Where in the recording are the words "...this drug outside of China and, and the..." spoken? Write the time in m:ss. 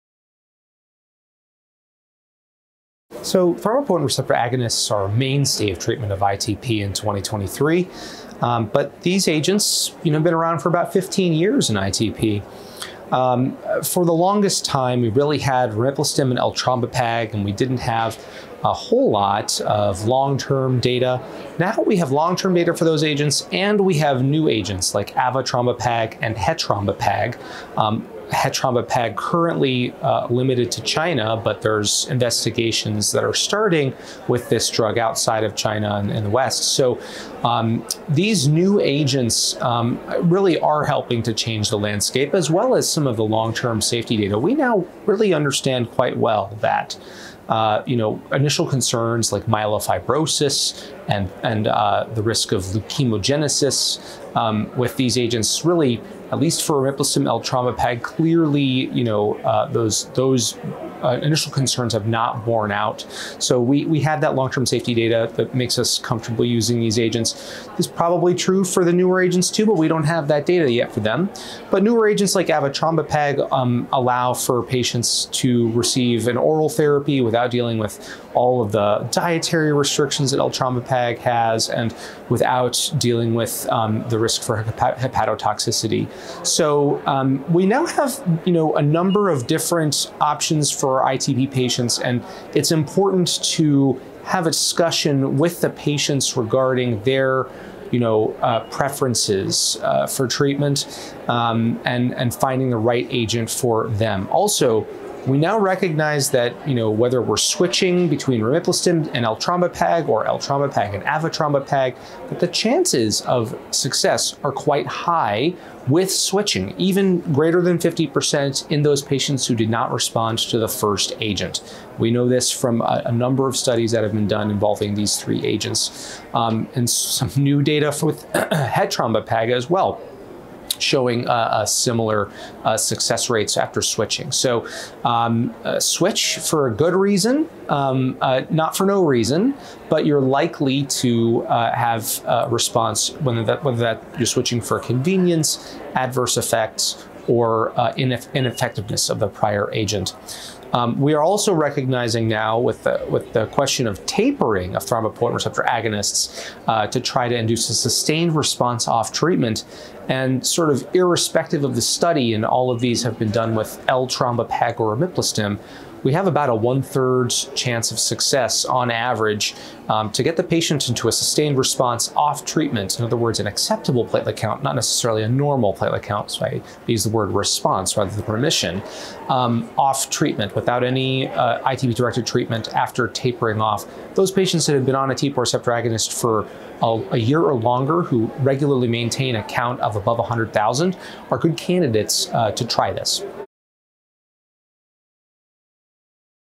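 0:34.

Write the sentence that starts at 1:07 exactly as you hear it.
This is probably true for the newer agents too, but we don't have that data yet for them.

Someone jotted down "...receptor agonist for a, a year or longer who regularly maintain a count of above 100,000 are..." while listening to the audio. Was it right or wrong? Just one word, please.
right.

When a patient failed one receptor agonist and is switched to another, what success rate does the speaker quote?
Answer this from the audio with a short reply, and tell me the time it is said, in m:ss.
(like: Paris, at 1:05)
greater than 50%, at 1:57.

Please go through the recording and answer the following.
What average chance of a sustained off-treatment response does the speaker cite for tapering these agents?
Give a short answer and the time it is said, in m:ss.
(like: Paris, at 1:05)
one-third, at 2:46.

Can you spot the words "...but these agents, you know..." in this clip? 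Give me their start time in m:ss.
0:08.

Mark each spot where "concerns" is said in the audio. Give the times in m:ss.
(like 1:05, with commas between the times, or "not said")
0:48, 1:01.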